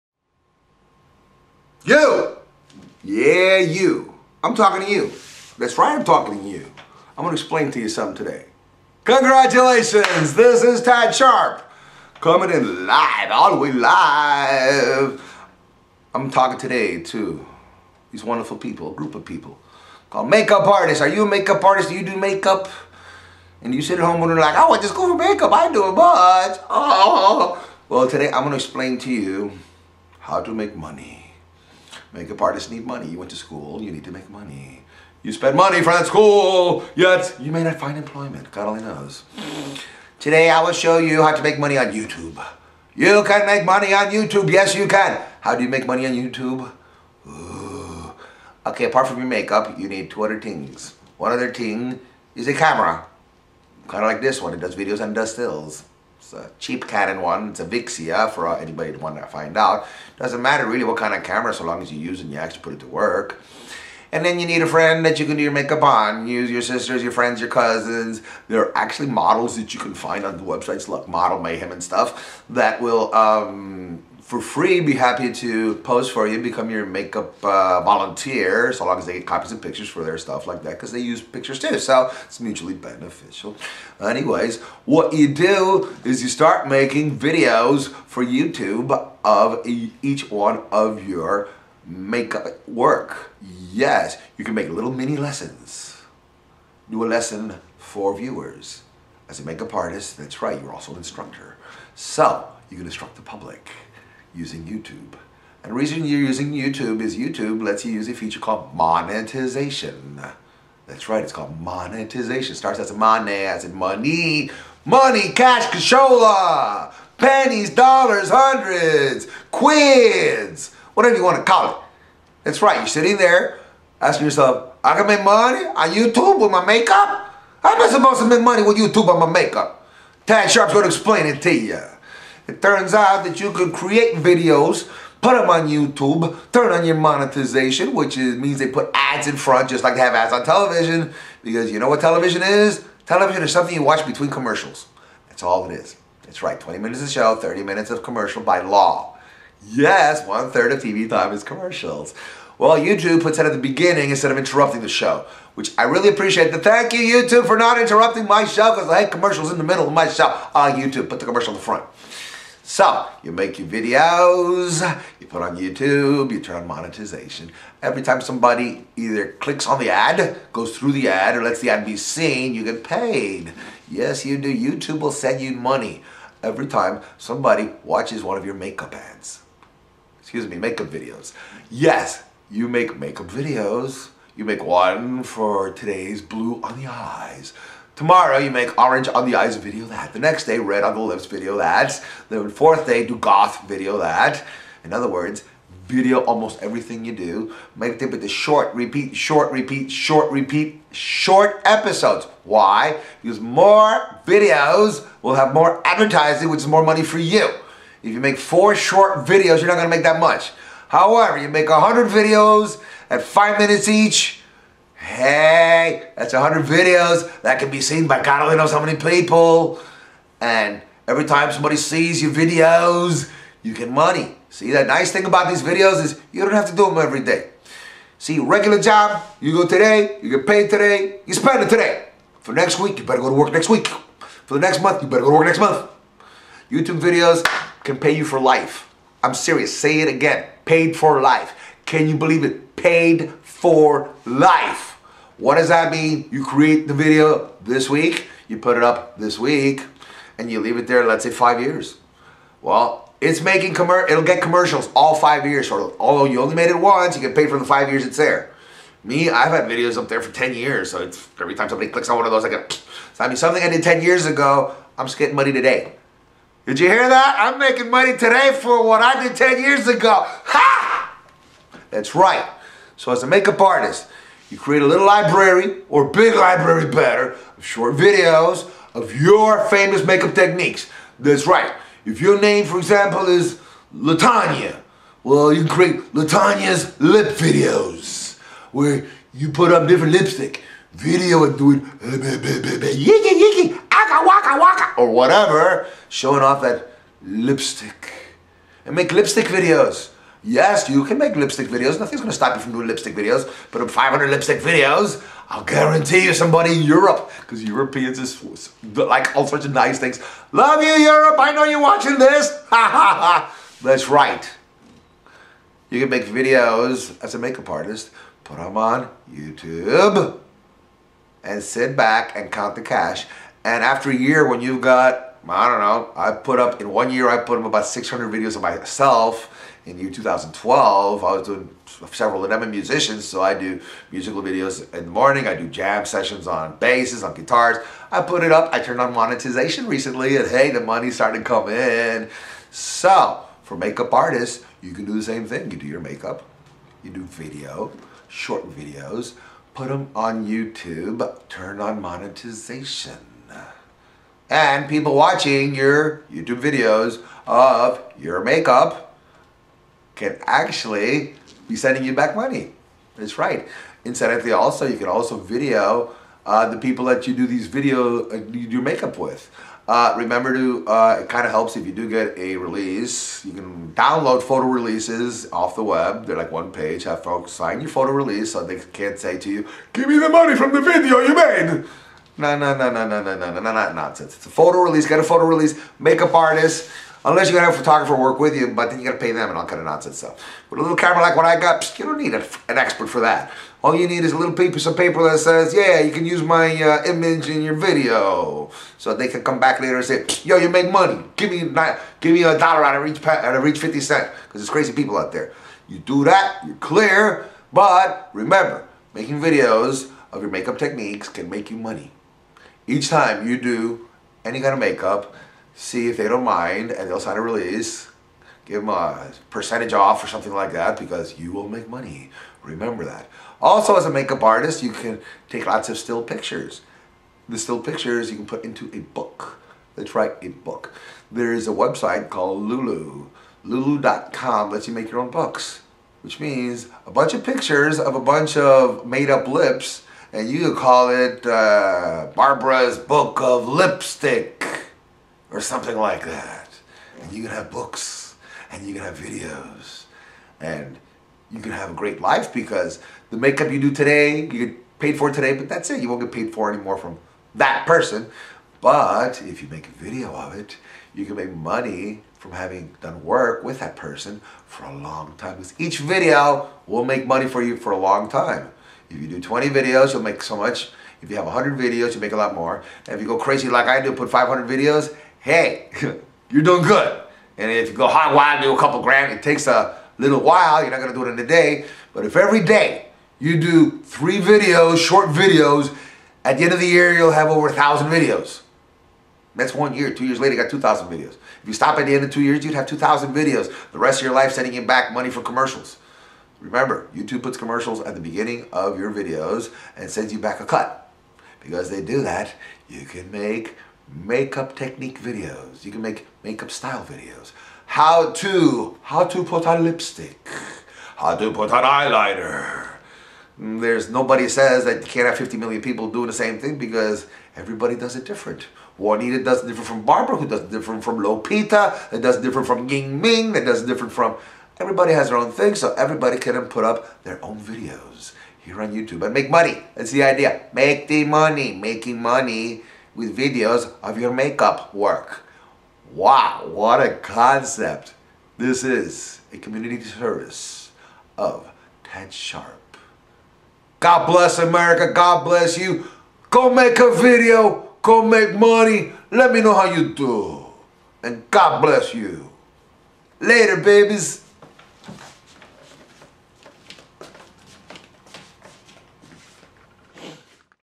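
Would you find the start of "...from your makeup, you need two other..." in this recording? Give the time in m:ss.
0:49.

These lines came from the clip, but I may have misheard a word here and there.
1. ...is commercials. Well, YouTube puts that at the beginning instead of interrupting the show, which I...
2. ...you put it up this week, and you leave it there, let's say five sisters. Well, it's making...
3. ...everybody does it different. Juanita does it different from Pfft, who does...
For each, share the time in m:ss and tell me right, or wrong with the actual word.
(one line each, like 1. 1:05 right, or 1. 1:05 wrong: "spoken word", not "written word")
1. 2:31 right
2. 4:08 wrong: "years", not "sisters"
3. 8:37 wrong: "Barbara", not "Pfft".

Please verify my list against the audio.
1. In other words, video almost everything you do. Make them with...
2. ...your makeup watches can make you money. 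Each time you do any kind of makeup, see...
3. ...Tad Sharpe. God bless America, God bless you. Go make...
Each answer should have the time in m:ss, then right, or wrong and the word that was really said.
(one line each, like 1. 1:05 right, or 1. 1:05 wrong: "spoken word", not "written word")
1. 3:14 right
2. 6:50 wrong: "techniques", not "watches"
3. 9:02 right.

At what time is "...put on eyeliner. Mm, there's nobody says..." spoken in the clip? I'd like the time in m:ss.
8:31.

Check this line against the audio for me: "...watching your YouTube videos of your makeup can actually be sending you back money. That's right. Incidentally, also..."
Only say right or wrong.
right.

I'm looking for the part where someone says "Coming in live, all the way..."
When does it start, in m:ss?
0:12.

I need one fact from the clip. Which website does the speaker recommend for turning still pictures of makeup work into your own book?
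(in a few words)
Lulu.com.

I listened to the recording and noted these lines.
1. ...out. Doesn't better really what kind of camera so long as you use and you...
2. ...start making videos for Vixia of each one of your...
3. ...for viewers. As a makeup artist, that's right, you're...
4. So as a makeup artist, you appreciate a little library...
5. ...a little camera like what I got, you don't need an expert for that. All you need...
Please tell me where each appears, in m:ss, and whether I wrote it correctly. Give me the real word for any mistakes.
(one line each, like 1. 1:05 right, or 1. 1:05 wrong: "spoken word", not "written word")
1. 0:59 wrong: "matter", not "better"
2. 1:26 wrong: "YouTube", not "Vixia"
3. 1:37 right
4. 4:33 wrong: "create", not "appreciate"
5. 6:30 right.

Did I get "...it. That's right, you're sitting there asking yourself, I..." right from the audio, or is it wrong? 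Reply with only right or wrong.
right.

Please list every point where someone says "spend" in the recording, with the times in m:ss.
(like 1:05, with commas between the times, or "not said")
0:35, 3:51.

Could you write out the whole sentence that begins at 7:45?
Because each video will make money for you for a long time.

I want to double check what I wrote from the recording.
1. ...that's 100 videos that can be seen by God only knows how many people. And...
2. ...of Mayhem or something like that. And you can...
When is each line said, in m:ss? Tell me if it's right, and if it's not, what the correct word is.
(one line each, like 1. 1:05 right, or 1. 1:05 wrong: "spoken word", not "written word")
1. 3:36 right
2. 7:23 wrong: "Lipstick", not "Mayhem".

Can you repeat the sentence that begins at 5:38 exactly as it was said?
I put it up, I turned on monetization recently, and hey, the money's starting to come in.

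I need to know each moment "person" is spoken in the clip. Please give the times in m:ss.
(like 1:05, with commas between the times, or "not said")
7:37, 7:43.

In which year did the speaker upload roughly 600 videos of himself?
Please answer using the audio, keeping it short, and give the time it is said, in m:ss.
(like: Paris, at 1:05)
2012, at 5:29.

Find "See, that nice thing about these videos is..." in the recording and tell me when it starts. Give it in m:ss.
3:44.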